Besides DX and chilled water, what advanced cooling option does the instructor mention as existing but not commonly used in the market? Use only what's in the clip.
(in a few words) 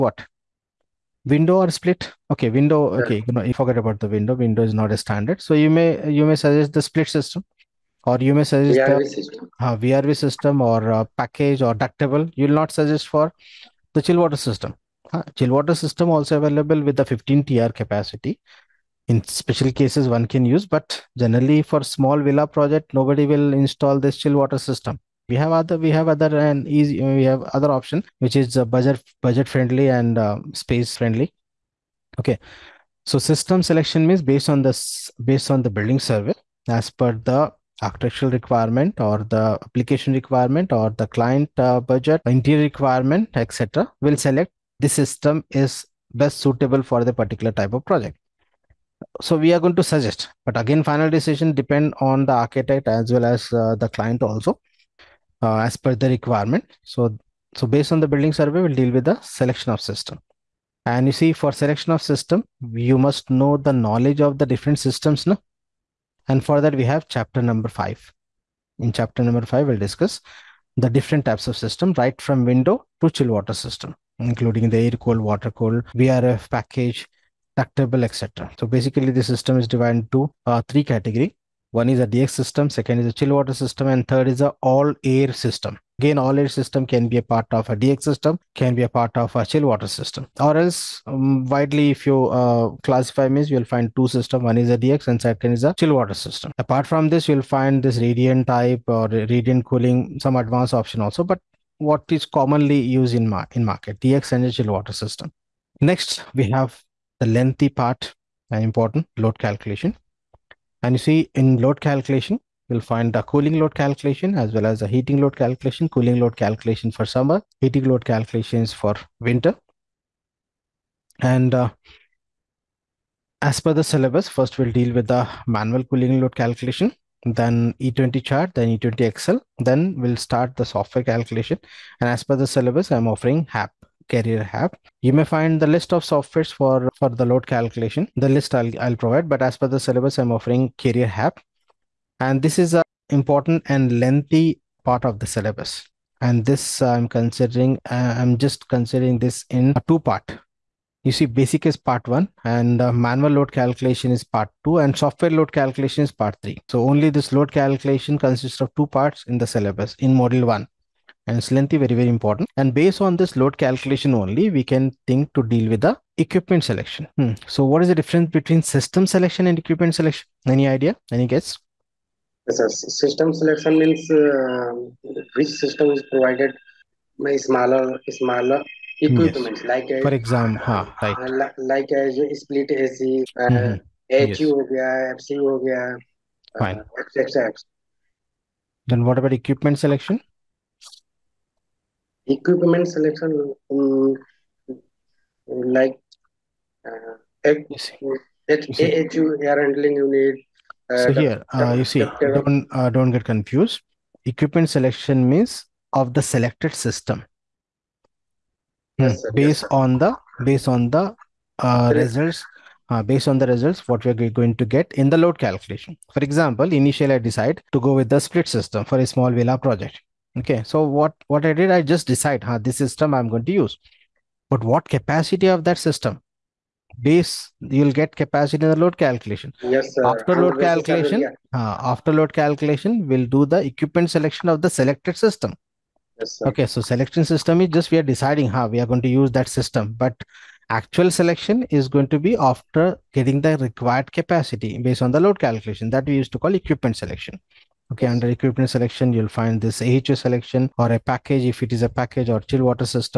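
Radiant cooling.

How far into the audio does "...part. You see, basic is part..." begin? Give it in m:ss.
2:29.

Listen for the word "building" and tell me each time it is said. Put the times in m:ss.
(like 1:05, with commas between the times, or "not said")
0:35, 0:58.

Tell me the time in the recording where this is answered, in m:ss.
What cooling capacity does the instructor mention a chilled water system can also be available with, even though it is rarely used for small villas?
0:17.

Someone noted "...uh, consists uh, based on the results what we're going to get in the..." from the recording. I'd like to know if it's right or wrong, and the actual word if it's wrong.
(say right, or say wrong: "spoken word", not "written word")
wrong: "results", not "consists".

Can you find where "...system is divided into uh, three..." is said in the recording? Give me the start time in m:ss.
1:19.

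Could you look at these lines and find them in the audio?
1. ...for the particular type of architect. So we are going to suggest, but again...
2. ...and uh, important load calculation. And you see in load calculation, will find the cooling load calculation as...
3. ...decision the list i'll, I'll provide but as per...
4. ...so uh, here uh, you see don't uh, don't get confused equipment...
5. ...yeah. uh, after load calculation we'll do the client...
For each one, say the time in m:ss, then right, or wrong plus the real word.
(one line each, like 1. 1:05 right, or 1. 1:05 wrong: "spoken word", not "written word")
1. 0:46 wrong: "project", not "architect"
2. 1:48 right
3. 2:17 wrong: "calculation", not "decision"
4. 3:20 right
5. 3:51 wrong: "equipment", not "client".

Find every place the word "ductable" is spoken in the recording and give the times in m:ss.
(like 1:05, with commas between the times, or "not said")
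0:11, 1:17.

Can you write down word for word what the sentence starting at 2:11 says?
And as per the syllabus, I'm offering HAP Carrier HAP.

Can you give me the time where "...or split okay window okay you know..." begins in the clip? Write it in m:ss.
0:01.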